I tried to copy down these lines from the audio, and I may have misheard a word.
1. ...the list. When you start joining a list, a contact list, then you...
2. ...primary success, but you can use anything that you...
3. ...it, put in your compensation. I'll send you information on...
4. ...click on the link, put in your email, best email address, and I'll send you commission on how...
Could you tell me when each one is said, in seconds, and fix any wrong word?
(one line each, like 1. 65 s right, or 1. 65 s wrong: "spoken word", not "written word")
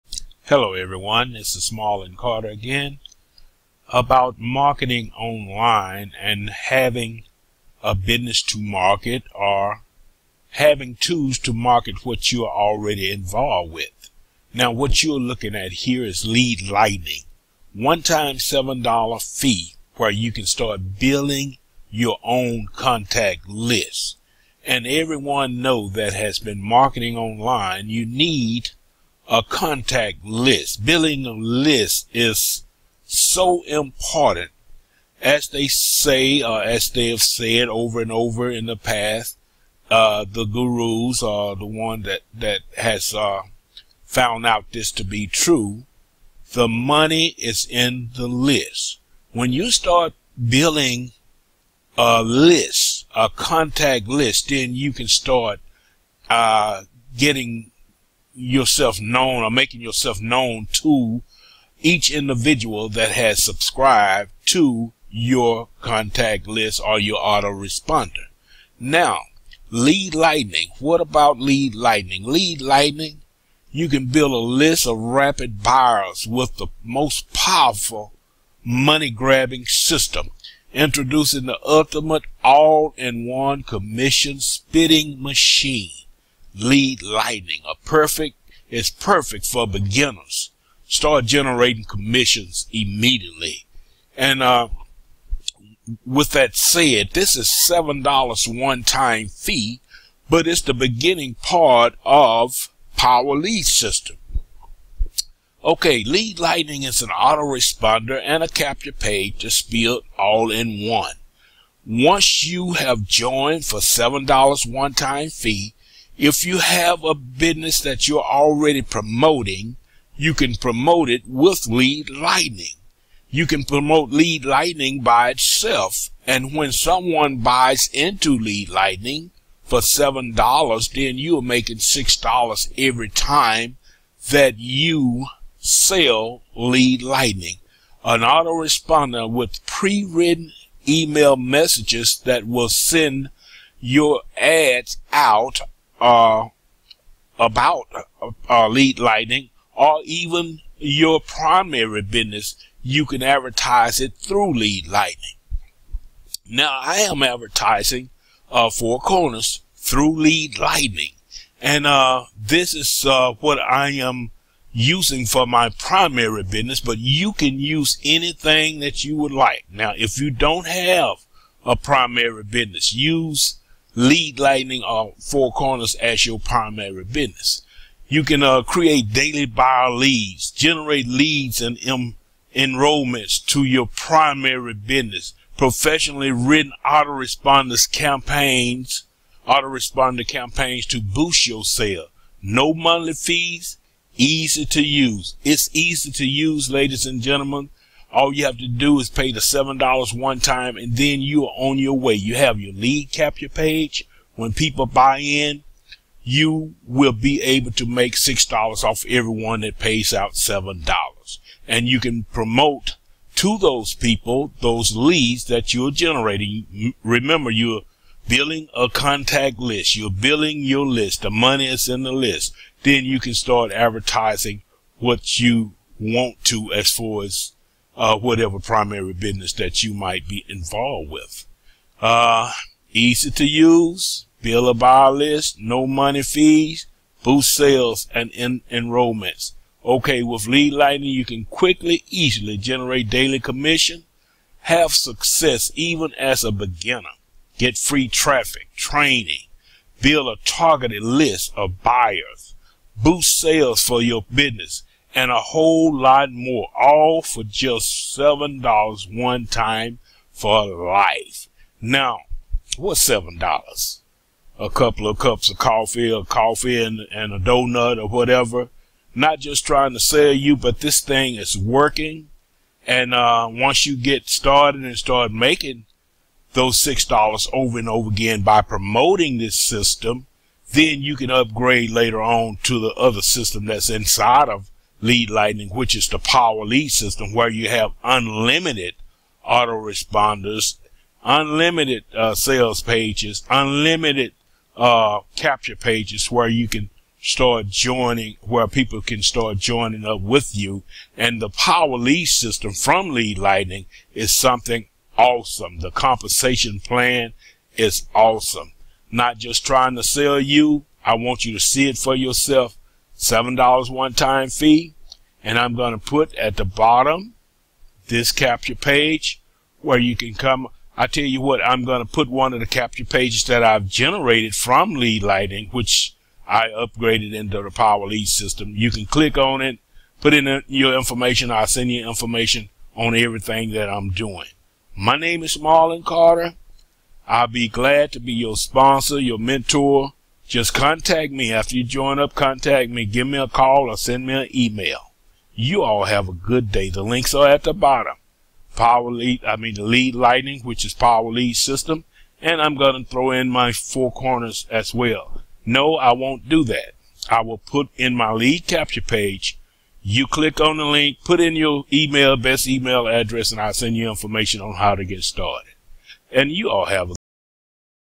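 1. 48 s wrong: "building", not "joining"
2. 165 s wrong: "business", not "success"
3. 329 s wrong: "information", not "compensation"
4. 360 s wrong: "information", not "commission".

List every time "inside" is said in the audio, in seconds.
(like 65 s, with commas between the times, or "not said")
283 s.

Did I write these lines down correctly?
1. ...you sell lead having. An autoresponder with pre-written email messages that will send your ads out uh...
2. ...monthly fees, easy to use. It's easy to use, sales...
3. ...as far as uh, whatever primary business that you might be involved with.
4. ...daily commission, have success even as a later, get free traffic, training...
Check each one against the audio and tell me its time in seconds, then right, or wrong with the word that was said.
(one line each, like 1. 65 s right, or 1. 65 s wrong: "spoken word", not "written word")
1. 134 s wrong: "lightning", not "having"
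2. 192 s wrong: "ladies", not "sales"
3. 226 s right
4. 243 s wrong: "beginner", not "later".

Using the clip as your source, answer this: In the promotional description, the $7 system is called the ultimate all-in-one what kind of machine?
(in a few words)
commission spitting machine.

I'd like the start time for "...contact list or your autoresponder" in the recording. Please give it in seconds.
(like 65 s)
65 s.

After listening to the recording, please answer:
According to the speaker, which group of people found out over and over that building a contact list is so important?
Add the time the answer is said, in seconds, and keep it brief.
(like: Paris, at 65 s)
the gurus, at 40 s.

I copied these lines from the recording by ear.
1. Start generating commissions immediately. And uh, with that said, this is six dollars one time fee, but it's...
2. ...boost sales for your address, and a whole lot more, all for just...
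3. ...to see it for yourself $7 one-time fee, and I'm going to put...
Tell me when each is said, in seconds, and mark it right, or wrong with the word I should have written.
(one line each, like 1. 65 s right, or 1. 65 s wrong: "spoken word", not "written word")
1. 90 s wrong: "seven", not "six"
2. 252 s wrong: "business", not "address"
3. 311 s right.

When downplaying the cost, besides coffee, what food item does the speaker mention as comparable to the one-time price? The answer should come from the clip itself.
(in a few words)
donut.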